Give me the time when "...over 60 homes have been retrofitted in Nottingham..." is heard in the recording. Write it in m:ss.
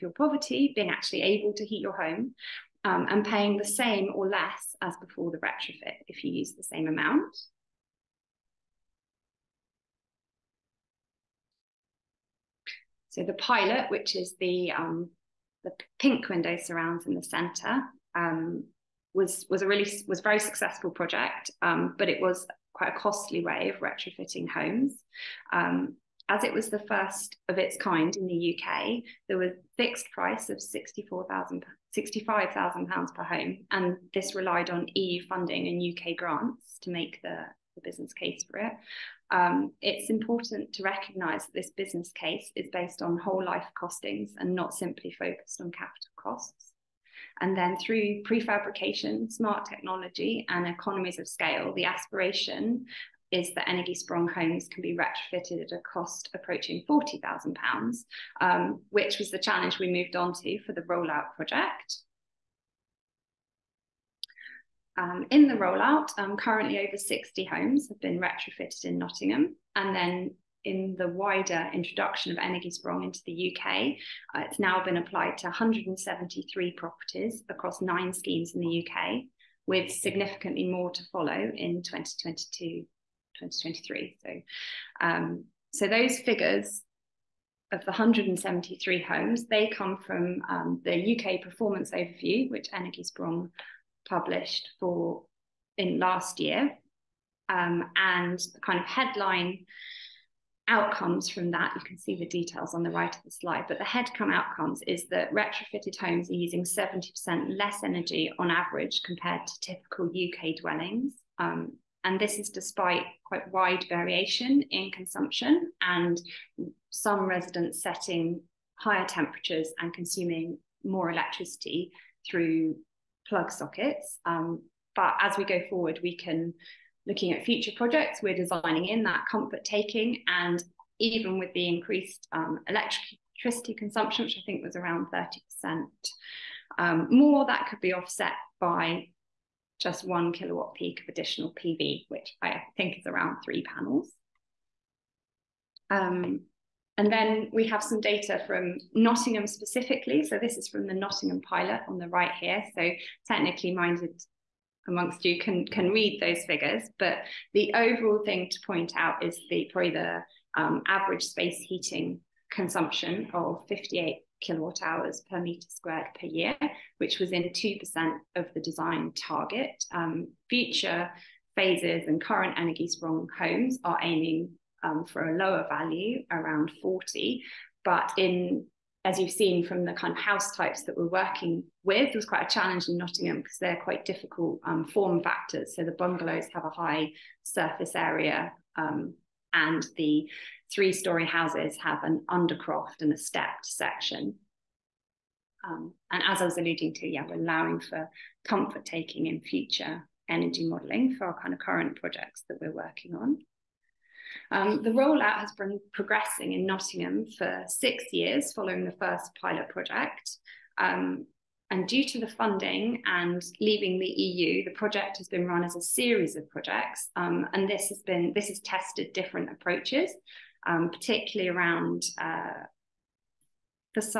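1:06.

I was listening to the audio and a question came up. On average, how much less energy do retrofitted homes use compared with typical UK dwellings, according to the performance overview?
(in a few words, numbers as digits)
70%.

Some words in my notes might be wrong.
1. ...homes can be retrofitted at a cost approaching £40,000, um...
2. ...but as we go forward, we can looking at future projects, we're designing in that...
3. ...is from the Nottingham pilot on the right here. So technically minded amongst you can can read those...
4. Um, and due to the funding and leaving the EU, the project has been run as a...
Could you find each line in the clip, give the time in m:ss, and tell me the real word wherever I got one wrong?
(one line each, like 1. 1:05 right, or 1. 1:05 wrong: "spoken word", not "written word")
1. 0:54 right
2. 2:04 right
3. 2:30 right
4. 3:30 right.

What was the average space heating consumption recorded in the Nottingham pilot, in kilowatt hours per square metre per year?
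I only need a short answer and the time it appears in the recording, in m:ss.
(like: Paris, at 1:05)
58, at 2:43.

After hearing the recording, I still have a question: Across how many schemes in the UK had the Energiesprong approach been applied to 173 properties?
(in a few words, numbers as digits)
9.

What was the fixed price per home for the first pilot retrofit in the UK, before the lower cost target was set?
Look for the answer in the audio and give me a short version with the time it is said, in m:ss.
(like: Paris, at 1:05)
£65,000, at 0:31.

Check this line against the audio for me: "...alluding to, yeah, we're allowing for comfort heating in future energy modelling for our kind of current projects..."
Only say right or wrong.
wrong.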